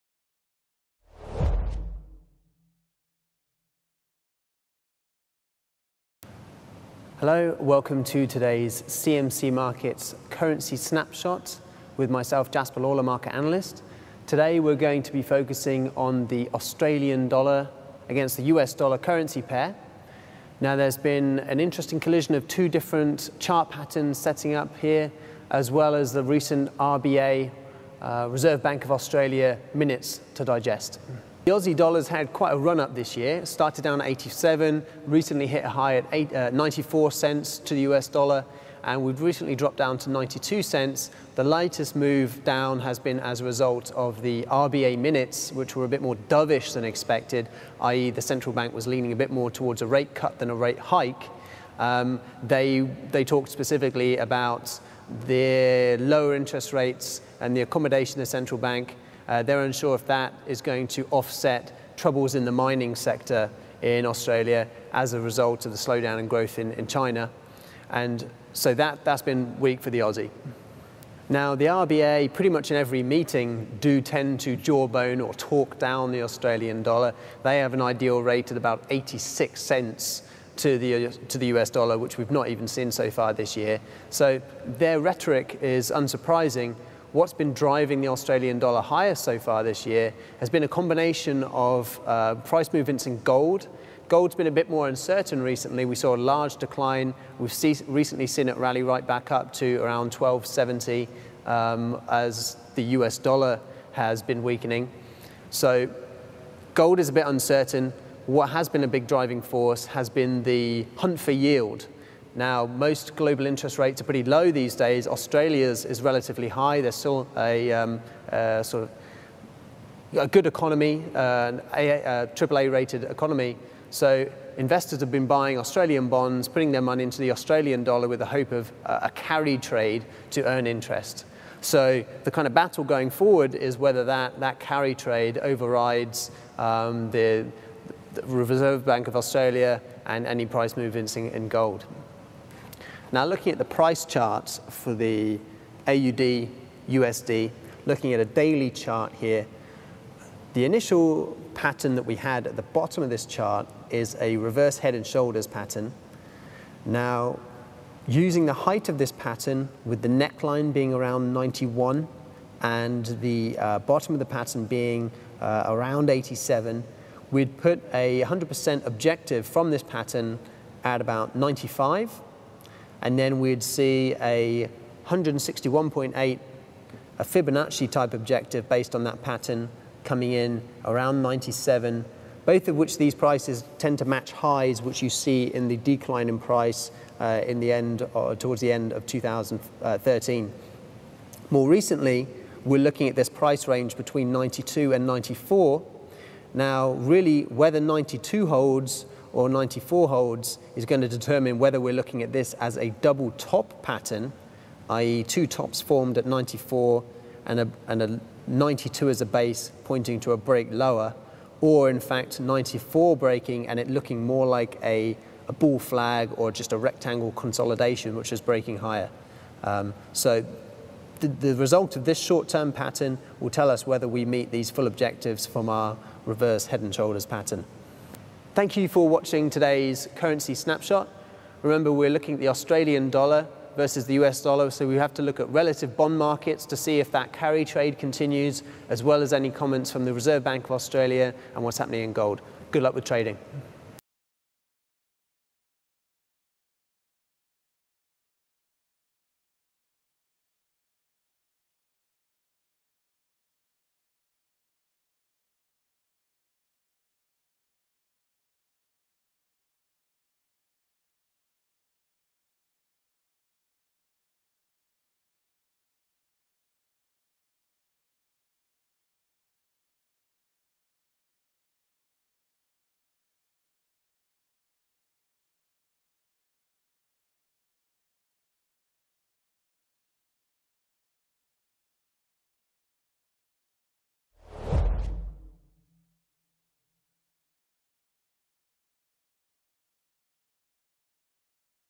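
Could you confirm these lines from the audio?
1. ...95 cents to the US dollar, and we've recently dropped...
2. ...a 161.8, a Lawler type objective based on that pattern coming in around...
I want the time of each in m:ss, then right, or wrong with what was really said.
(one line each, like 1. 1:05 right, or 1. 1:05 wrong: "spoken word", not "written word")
1. 0:36 wrong: "94", not "95"
2. 2:54 wrong: "Fibonacci", not "Lawler".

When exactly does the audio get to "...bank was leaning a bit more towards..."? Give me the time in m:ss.
0:48.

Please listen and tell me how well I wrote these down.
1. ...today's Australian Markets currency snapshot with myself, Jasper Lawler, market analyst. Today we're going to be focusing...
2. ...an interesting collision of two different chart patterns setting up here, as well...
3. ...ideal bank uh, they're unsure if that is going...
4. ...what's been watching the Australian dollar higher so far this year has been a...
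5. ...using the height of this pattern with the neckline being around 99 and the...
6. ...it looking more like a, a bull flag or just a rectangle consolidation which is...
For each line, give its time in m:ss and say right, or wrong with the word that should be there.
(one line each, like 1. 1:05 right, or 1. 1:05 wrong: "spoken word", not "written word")
1. 0:08 wrong: "CMC", not "Australian"
2. 0:21 right
3. 0:58 wrong: "central", not "ideal"
4. 1:27 wrong: "driving", not "watching"
5. 2:38 wrong: "91", not "99"
6. 3:33 right.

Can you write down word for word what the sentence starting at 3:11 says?
More recently, we're looking at this price range between 92 and 94.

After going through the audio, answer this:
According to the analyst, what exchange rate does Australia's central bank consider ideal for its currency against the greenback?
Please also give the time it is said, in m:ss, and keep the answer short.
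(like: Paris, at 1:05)
86 cents, at 1:18.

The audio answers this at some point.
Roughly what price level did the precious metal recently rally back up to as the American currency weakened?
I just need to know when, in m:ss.
1:40.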